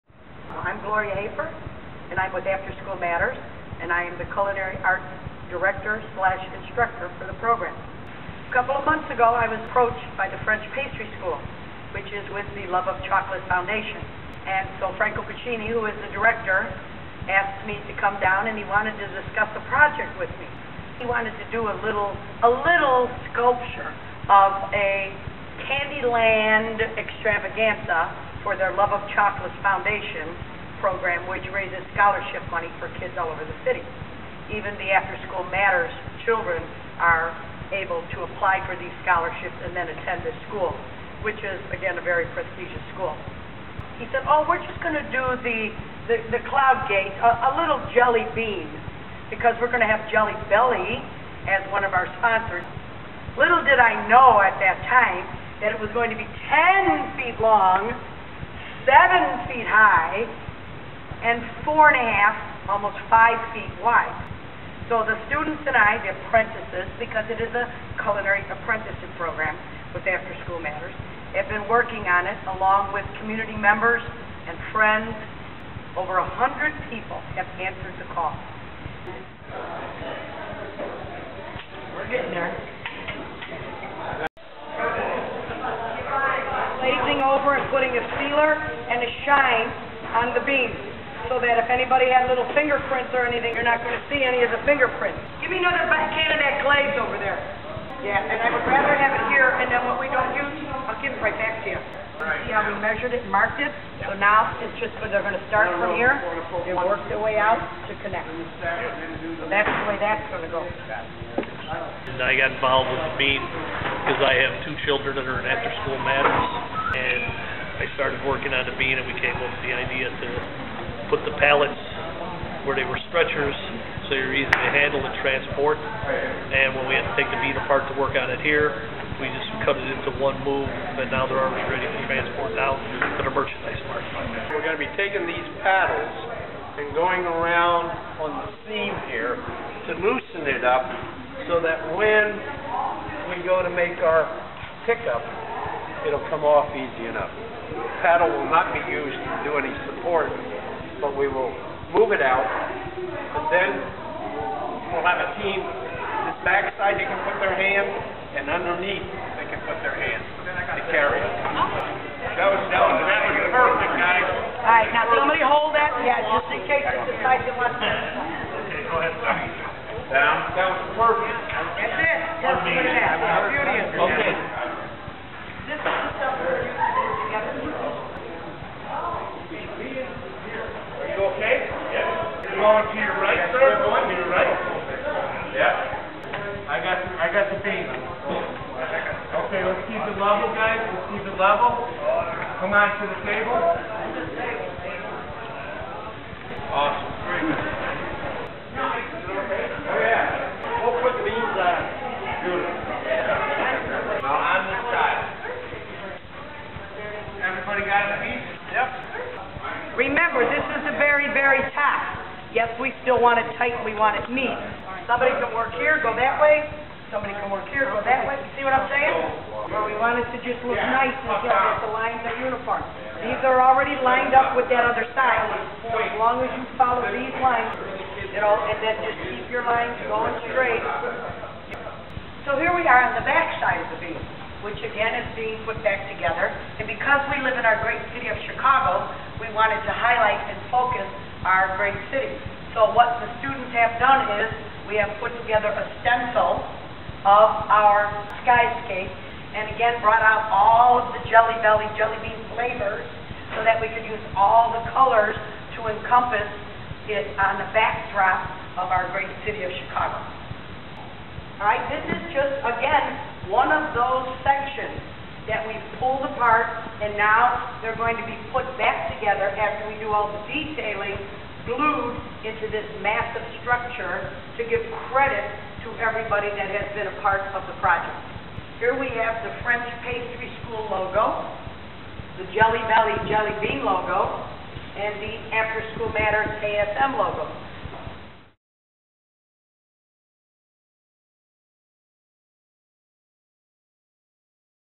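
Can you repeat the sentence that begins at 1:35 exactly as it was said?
Give me another can of that glaze over there.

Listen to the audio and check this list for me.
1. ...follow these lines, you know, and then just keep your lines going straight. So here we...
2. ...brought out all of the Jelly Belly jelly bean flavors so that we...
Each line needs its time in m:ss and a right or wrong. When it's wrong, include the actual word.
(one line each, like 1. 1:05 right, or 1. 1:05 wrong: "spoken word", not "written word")
1. 3:46 right
2. 4:10 right.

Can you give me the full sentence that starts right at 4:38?
Here we have the French Pastry School logo, the Jelly Belly Jelly Bean logo, and the After School Matters ASM logo.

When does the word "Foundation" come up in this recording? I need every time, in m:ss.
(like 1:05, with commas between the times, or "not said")
0:13, 0:29.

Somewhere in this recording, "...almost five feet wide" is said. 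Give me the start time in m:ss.
1:02.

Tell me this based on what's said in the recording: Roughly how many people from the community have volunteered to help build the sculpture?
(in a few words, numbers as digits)
Over 100.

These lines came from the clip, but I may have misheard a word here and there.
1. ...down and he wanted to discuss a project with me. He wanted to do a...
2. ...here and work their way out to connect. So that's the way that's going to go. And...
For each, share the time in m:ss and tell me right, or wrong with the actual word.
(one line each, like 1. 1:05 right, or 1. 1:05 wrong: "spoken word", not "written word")
1. 0:18 right
2. 1:45 right.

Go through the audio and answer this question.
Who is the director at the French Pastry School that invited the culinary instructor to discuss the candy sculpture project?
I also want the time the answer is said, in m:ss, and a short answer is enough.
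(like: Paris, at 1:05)
Franco Pacini, at 0:14.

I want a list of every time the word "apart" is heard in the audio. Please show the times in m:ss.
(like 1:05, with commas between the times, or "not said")
2:07, 4:26.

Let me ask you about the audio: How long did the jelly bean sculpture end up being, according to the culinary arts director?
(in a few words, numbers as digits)
10 feet.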